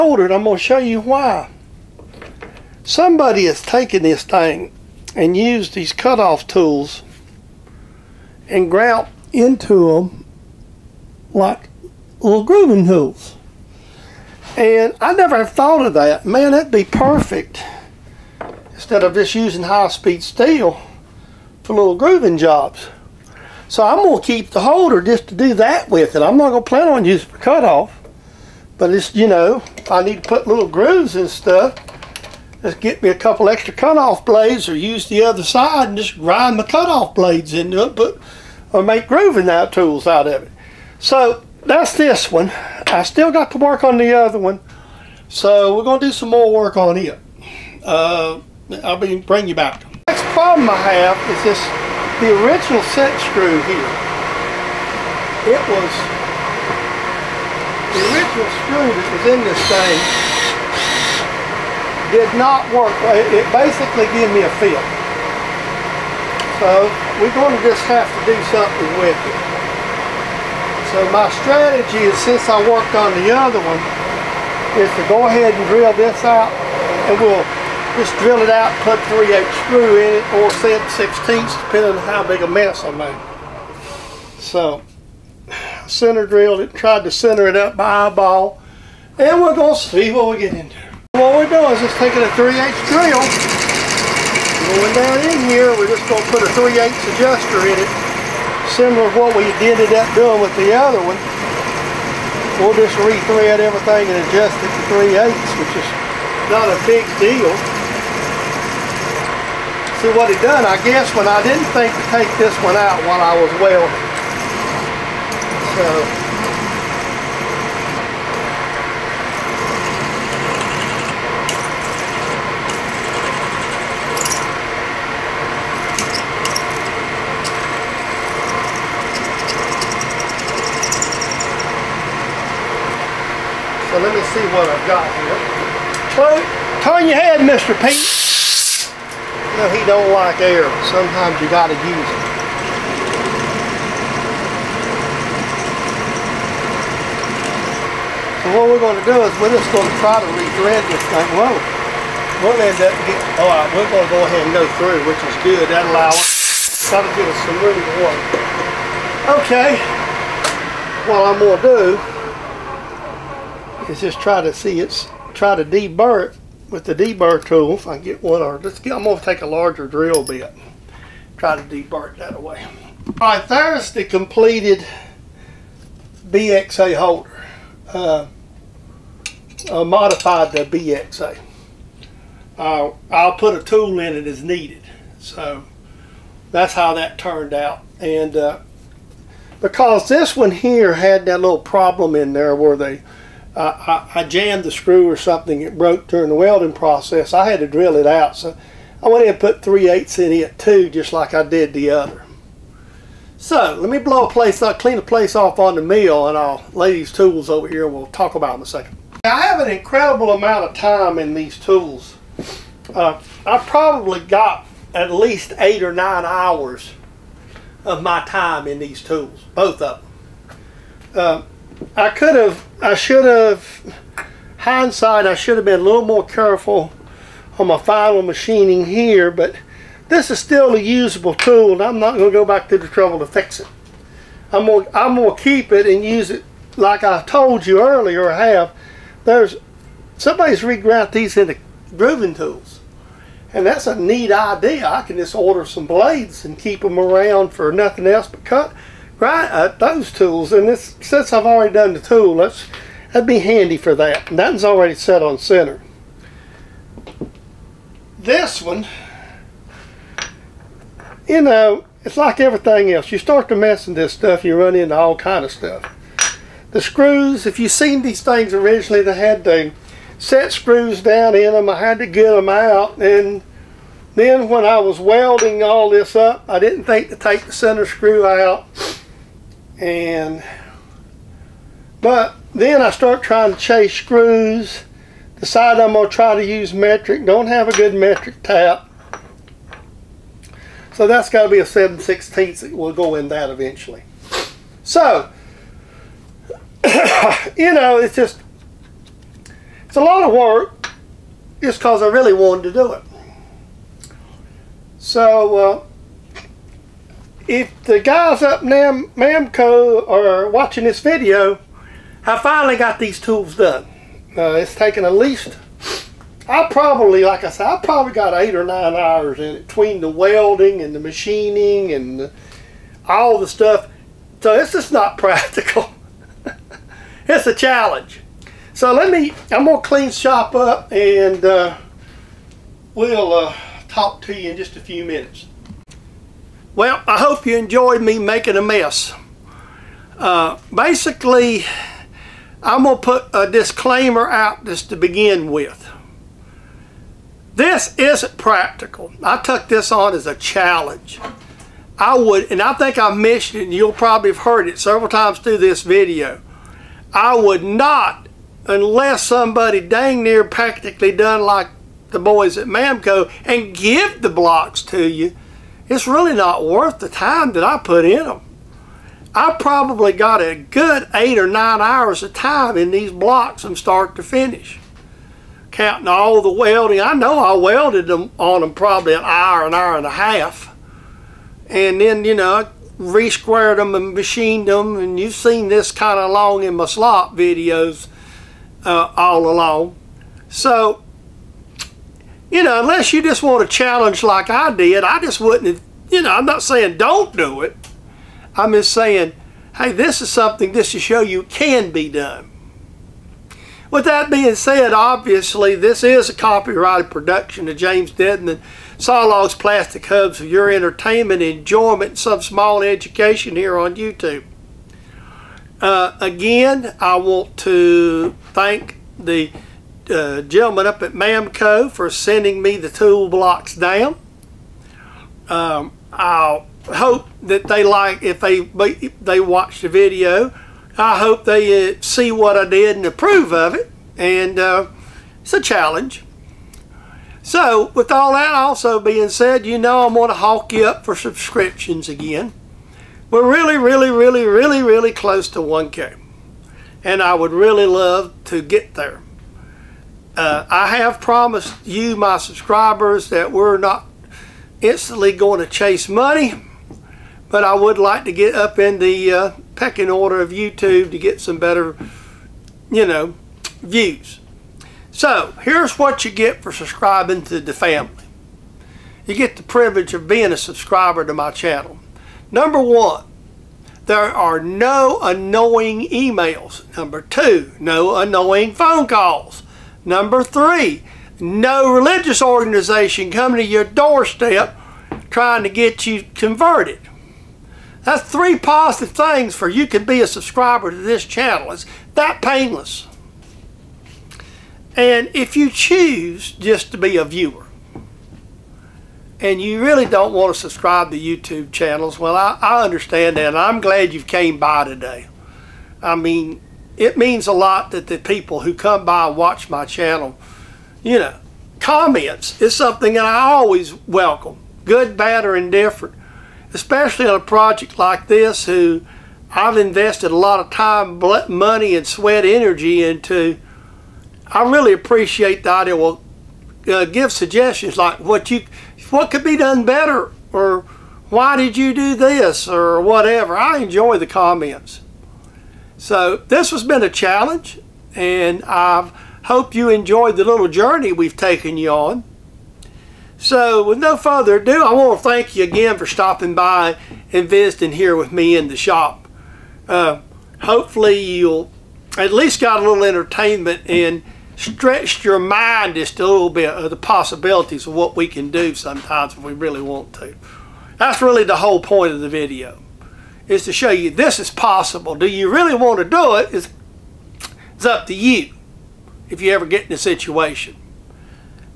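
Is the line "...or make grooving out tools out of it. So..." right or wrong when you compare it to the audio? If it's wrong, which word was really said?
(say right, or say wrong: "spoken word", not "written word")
right.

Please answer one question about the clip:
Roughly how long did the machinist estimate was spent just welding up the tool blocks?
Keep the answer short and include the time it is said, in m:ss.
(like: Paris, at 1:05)
an hour and a half, at 6:19.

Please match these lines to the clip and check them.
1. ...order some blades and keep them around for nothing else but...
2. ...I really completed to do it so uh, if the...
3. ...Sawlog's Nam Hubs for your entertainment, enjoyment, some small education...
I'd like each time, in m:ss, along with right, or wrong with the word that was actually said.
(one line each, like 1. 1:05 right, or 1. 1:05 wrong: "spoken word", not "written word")
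1. 4:05 right
2. 5:02 wrong: "wanted", not "completed"
3. 6:48 wrong: "Plastic", not "Nam".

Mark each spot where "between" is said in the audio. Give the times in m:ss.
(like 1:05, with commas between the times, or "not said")
5:19.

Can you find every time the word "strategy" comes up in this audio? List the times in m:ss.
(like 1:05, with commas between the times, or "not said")
1:11.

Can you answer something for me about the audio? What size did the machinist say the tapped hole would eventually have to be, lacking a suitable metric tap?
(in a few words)
7/16.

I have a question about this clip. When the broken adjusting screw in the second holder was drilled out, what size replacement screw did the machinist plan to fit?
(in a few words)
3/8.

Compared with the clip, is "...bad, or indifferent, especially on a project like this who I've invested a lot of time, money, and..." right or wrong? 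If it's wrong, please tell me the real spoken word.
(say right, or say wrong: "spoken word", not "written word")
right.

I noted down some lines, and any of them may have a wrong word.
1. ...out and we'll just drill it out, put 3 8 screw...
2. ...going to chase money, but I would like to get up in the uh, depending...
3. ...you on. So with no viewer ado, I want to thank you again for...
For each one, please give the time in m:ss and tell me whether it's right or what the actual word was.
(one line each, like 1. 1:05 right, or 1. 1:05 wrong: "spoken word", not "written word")
1. 1:16 right
2. 7:35 wrong: "pecking", not "depending"
3. 9:01 wrong: "further", not "viewer".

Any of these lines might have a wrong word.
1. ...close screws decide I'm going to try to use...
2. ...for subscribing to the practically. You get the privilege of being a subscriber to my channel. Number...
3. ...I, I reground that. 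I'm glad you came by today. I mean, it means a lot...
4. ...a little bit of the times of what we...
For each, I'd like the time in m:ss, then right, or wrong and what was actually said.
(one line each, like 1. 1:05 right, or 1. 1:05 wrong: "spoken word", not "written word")
1. 4:43 wrong: "chase", not "close"
2. 7:46 wrong: "family", not "practically"
3. 8:22 wrong: "understand", not "reground"
4. 9:16 wrong: "possibilities", not "times".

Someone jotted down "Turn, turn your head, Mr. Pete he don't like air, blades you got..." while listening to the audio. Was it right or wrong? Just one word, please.
wrong.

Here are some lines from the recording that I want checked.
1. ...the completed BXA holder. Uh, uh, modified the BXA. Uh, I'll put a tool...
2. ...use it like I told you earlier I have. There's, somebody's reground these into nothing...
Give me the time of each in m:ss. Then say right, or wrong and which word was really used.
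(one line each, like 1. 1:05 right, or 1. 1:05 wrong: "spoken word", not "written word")
1. 2:53 right
2. 3:56 wrong: "grooving", not "nothing".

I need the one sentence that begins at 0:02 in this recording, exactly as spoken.
Somebody has taken this thing and used these cutoff tools and grout into them like little grooving tools.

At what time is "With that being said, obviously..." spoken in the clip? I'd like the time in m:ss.
6:43.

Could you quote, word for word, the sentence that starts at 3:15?
It broke during the welding process.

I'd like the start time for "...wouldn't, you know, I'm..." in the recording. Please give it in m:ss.
6:35.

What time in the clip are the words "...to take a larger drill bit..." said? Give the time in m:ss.
2:49.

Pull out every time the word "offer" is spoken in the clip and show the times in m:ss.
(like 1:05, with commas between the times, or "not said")
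not said.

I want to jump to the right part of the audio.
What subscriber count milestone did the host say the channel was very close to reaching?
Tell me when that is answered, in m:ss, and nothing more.
7:25.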